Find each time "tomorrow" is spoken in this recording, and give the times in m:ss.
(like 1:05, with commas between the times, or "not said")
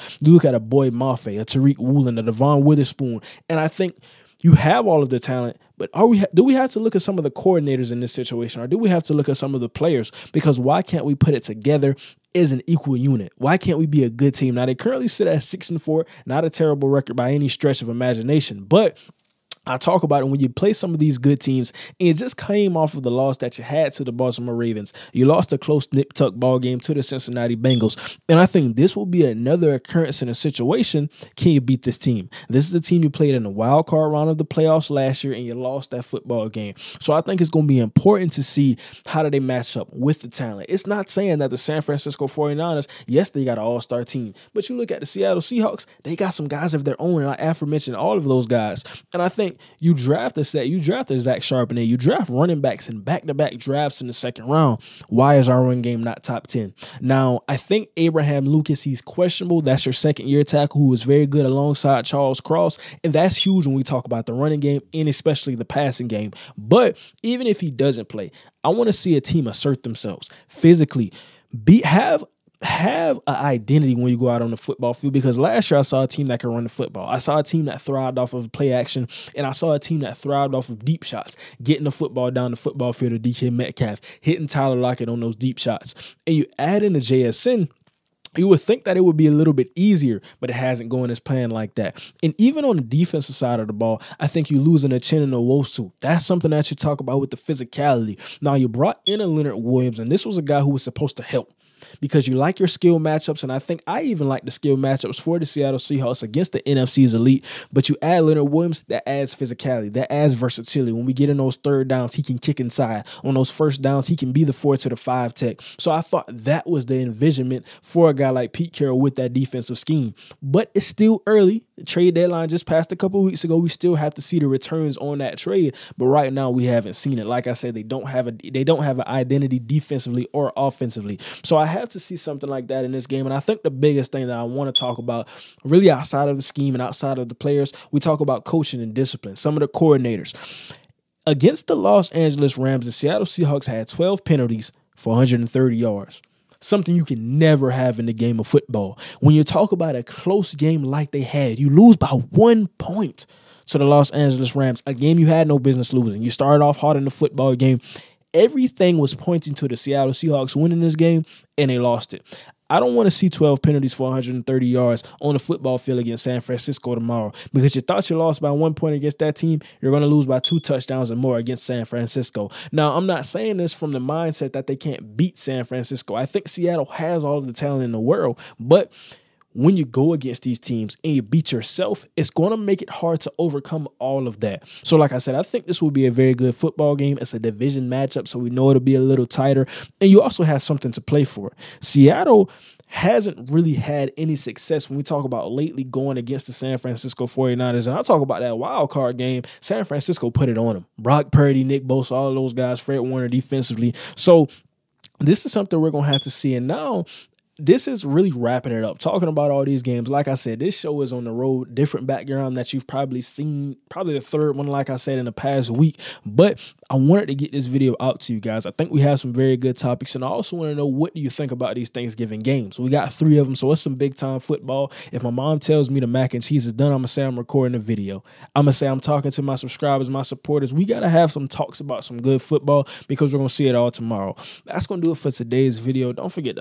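2:46, 3:53.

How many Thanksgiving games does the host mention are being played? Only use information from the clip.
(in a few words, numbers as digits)
3.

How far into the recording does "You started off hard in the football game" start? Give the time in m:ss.
2:36.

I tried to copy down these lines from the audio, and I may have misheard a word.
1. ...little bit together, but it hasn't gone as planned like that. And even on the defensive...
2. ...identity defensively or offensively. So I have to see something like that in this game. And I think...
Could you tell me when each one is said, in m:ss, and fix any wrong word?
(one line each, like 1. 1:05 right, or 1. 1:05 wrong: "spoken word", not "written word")
1. 1:29 wrong: "easier", not "together"
2. 2:09 right.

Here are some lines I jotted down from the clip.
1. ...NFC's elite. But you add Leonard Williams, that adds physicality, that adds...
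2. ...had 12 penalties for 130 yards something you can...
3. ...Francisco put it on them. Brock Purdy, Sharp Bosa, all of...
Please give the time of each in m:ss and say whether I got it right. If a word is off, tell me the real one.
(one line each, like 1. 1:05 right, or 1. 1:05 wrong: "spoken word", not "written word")
1. 1:46 right
2. 2:23 right
3. 3:19 wrong: "Nick", not "Sharp".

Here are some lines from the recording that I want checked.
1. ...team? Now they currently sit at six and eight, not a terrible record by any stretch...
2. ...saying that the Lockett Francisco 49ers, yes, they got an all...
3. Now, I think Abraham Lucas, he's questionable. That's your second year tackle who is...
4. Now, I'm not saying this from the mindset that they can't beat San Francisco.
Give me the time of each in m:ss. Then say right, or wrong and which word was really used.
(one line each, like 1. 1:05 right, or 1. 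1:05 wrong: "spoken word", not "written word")
1. 0:14 wrong: "four", not "eight"
2. 0:41 wrong: "San", not "Lockett"
3. 0:56 right
4. 2:52 right.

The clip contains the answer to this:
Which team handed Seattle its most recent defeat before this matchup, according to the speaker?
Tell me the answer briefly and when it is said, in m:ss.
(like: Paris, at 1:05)
Baltimore Ravens, at 0:24.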